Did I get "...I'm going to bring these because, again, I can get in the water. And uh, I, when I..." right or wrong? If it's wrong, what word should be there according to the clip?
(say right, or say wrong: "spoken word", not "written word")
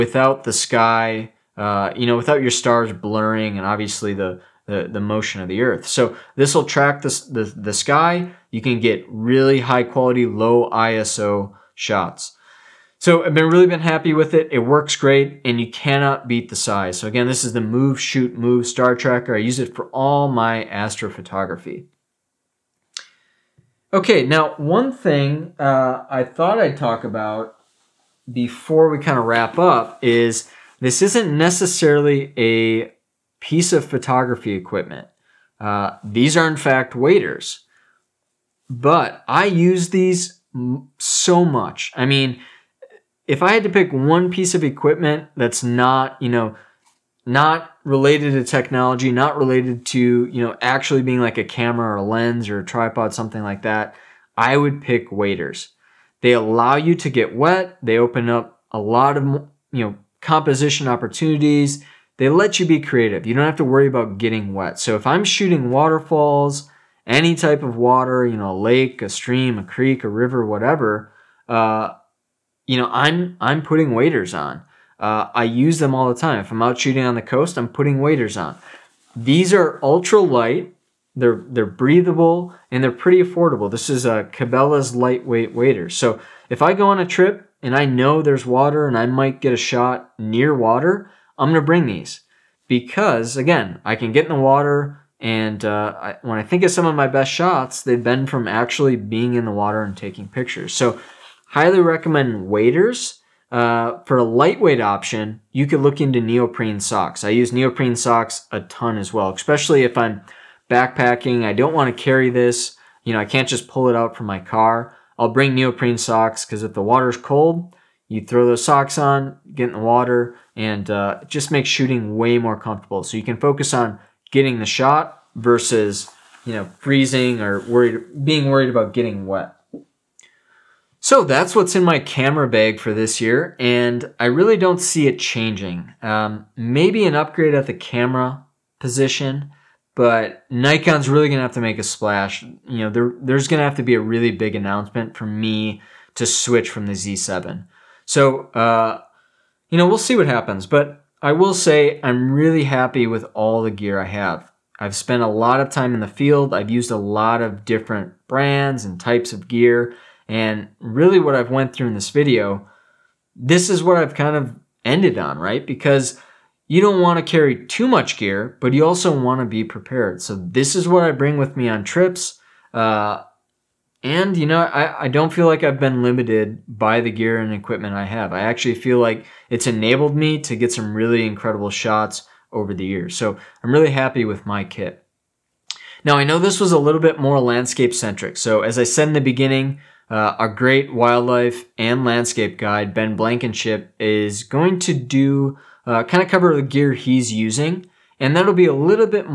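right.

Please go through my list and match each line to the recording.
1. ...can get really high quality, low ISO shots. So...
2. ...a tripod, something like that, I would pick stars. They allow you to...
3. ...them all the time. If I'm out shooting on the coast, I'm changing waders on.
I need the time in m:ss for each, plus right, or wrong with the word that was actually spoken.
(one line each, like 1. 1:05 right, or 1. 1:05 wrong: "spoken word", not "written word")
1. 0:08 right
2. 0:52 wrong: "waders", not "stars"
3. 1:15 wrong: "putting", not "changing".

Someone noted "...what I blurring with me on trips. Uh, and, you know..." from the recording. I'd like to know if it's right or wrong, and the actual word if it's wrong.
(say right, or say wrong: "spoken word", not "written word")
wrong: "bring", not "blurring".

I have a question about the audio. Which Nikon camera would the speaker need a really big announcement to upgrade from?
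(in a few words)
Z7.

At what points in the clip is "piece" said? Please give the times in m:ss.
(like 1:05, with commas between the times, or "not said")
0:33, 0:44.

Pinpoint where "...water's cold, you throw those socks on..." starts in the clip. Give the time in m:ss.
1:56.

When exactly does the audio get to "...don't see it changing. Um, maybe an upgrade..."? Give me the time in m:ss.
2:14.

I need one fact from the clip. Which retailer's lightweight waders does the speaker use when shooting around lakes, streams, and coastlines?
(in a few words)
Cabela's.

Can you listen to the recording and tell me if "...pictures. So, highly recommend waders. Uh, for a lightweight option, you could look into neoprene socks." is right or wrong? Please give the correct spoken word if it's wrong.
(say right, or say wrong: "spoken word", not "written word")
right.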